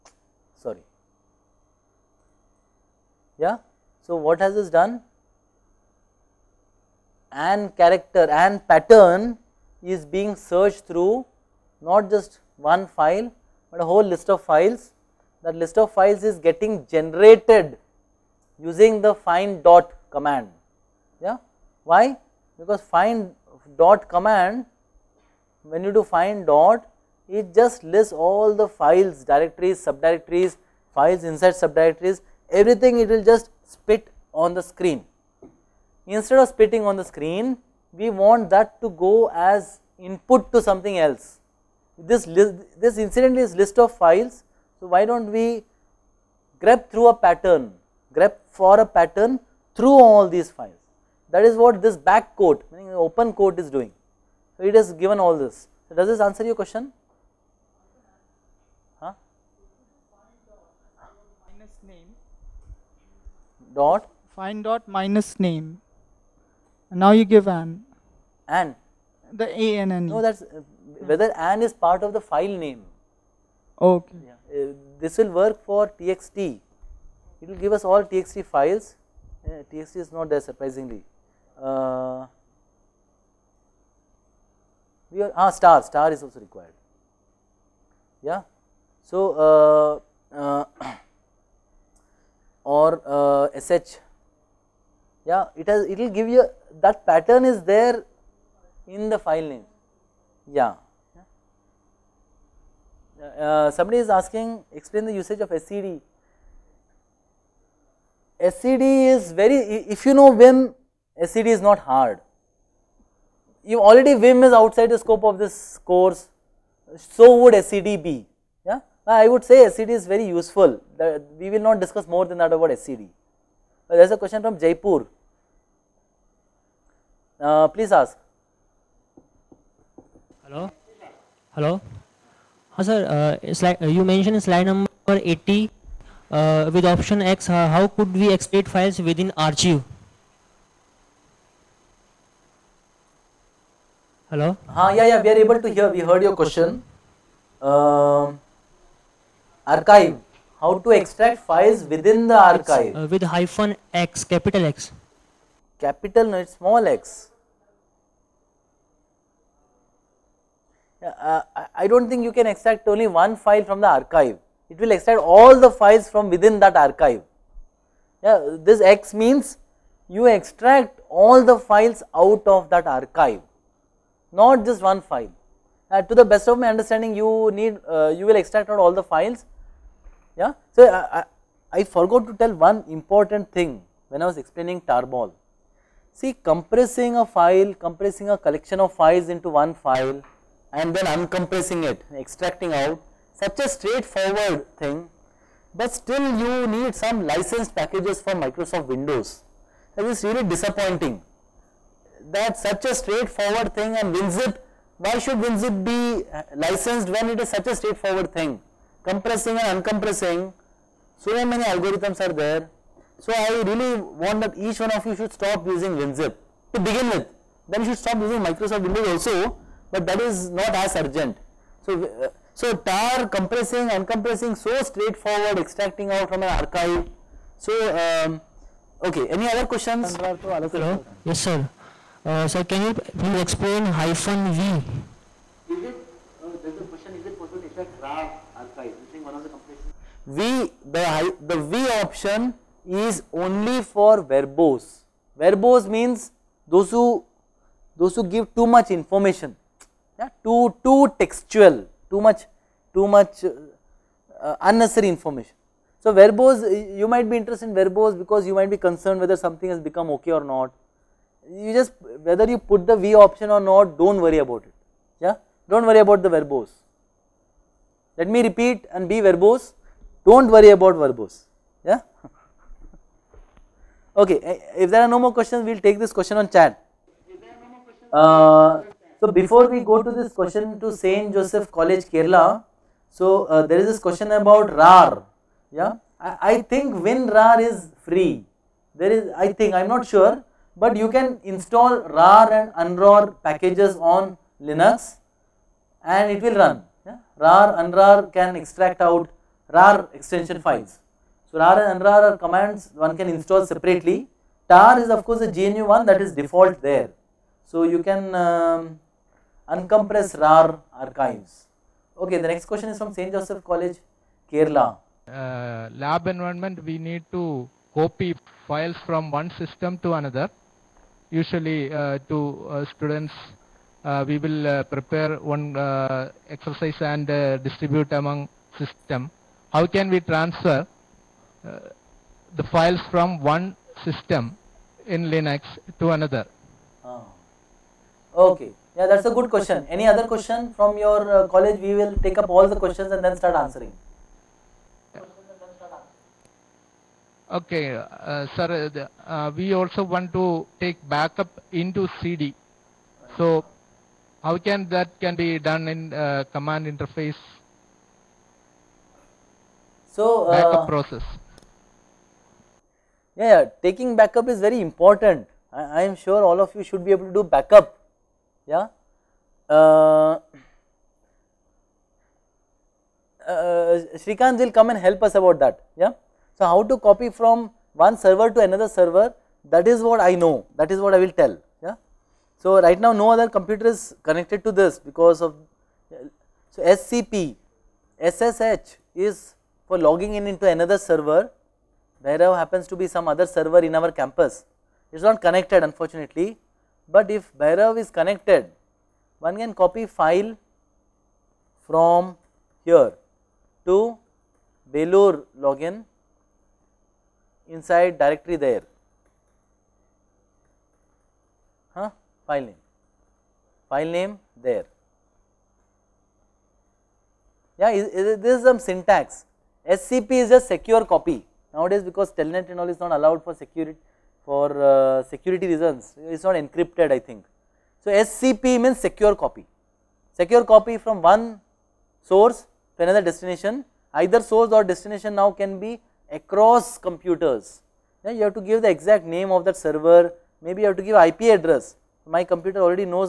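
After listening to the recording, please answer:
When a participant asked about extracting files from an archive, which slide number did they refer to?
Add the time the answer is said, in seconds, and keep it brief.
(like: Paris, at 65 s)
80, at 134 s.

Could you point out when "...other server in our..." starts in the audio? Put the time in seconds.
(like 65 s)
393 s.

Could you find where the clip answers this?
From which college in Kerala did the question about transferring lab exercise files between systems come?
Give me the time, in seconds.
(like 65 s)
313 s.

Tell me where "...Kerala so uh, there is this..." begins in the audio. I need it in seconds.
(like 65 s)
282 s.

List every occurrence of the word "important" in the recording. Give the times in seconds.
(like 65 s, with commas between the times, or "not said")
182 s, 364 s.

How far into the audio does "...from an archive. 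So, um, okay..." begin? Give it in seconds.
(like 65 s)
226 s.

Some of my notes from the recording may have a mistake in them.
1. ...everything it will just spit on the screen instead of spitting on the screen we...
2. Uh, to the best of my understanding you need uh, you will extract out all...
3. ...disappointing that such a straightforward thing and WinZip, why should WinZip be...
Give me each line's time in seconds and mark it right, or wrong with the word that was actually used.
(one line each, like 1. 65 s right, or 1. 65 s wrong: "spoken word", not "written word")
1. 32 s right
2. 175 s right
3. 200 s right.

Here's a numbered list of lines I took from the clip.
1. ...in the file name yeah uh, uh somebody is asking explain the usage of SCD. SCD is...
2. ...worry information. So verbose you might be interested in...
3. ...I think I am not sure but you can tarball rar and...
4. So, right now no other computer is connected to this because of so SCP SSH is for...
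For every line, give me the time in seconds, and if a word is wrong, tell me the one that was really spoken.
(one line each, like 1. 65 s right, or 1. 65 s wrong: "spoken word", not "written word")
1. 98 s right
2. 254 s wrong: "unnecessary", not "worry"
3. 289 s wrong: "install", not "tarball"
4. 382 s right.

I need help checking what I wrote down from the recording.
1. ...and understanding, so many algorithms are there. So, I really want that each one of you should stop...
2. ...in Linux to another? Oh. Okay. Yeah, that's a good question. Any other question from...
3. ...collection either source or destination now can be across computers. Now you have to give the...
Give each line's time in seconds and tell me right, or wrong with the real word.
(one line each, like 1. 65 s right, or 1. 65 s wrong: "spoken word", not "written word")
1. 209 s wrong: "uncompressing", not "understanding"
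2. 335 s right
3. 433 s wrong: "destination", not "collection".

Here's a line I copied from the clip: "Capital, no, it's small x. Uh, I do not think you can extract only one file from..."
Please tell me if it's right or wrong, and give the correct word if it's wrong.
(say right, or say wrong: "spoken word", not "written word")
right.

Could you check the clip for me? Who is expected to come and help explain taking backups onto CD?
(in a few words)
Srikant.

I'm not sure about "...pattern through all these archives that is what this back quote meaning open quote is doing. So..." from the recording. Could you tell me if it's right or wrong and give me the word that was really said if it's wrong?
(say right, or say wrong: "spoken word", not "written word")
wrong: "files", not "archives".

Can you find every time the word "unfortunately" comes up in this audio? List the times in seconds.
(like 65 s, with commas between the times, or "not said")
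395 s.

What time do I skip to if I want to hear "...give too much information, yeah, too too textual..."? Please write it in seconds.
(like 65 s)
248 s.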